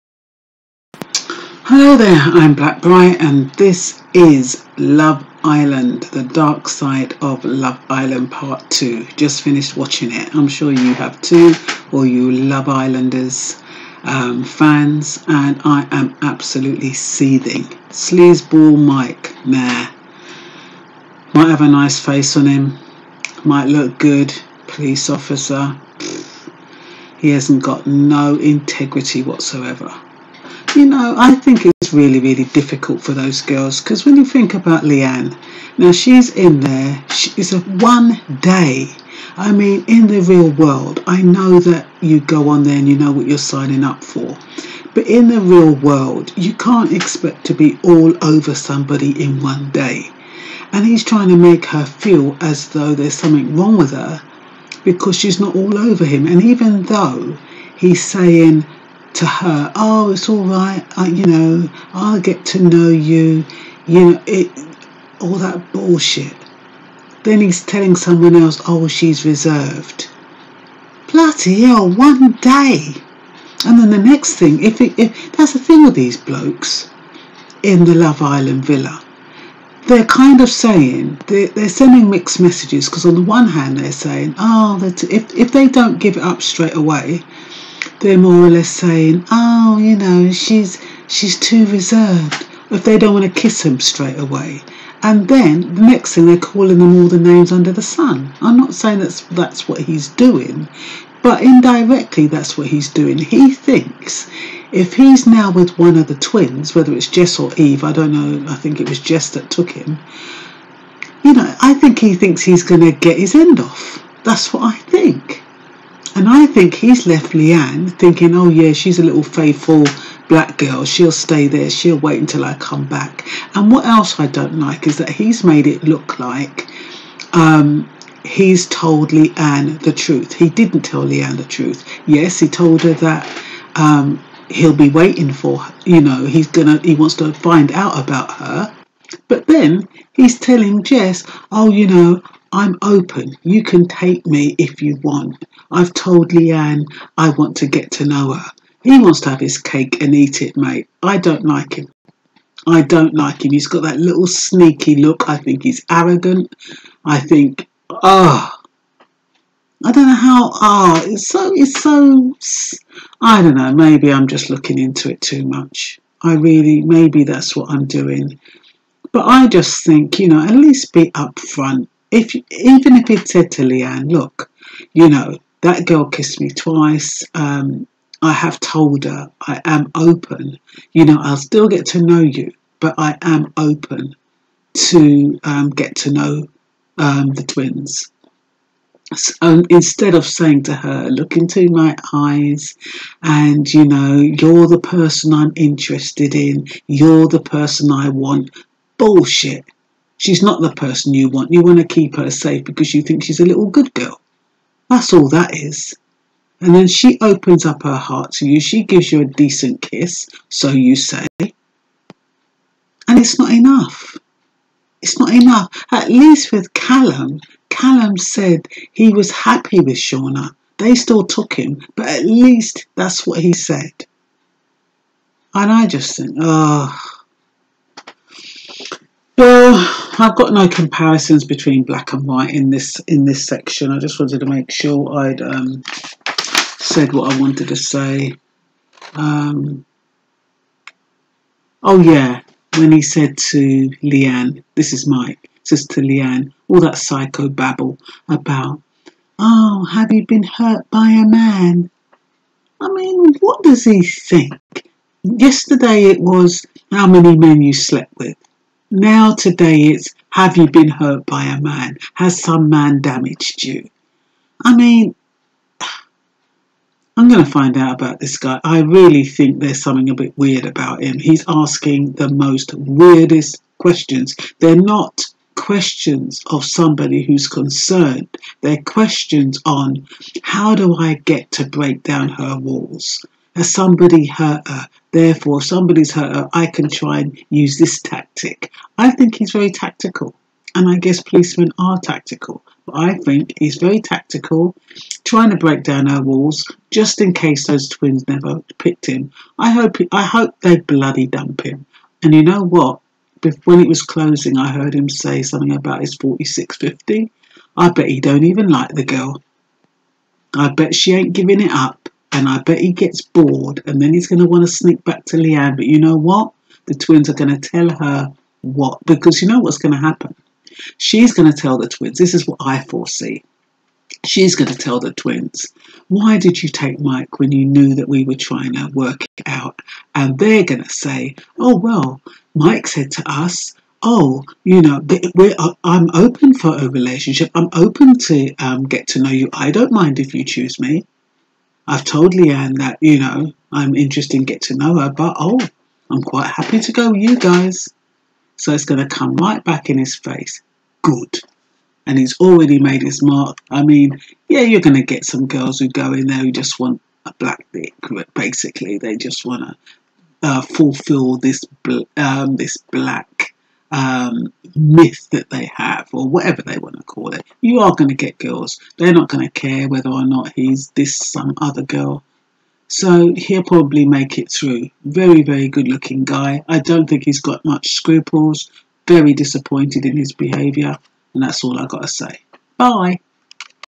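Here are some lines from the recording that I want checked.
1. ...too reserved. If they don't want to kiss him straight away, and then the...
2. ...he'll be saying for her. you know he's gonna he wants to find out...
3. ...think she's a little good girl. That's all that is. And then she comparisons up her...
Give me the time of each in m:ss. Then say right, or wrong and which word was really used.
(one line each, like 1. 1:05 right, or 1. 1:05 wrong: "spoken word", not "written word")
1. 1:31 right
2. 2:14 wrong: "waiting", not "saying"
3. 3:23 wrong: "opens", not "comparisons".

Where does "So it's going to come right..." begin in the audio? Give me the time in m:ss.
5:48.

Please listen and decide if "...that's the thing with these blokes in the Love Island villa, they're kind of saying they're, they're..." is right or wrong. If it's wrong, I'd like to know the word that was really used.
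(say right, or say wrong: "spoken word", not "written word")
right.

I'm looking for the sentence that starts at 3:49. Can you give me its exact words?
Well, I've got no comparisons between black and white in this in this section.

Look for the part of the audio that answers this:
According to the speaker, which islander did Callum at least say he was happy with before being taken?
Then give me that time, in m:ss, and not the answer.
3:39.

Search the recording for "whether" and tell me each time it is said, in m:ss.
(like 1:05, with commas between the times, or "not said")
1:46, 6:09.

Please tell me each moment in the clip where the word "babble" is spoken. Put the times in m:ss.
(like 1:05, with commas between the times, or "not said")
4:07.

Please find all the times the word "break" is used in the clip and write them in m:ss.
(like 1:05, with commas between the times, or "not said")
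4:41, 4:55.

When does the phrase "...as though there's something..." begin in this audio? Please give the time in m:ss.
0:52.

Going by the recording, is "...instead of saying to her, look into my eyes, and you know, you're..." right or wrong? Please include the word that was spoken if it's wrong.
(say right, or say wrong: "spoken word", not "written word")
right.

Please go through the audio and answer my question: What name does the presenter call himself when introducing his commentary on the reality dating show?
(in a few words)
Black Bright.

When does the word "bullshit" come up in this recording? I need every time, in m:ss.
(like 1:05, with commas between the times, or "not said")
1:05, 3:18.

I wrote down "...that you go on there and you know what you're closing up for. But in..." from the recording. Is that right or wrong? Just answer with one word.
wrong.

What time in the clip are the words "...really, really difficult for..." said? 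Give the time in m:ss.
0:31.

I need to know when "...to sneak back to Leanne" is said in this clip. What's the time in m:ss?
5:14.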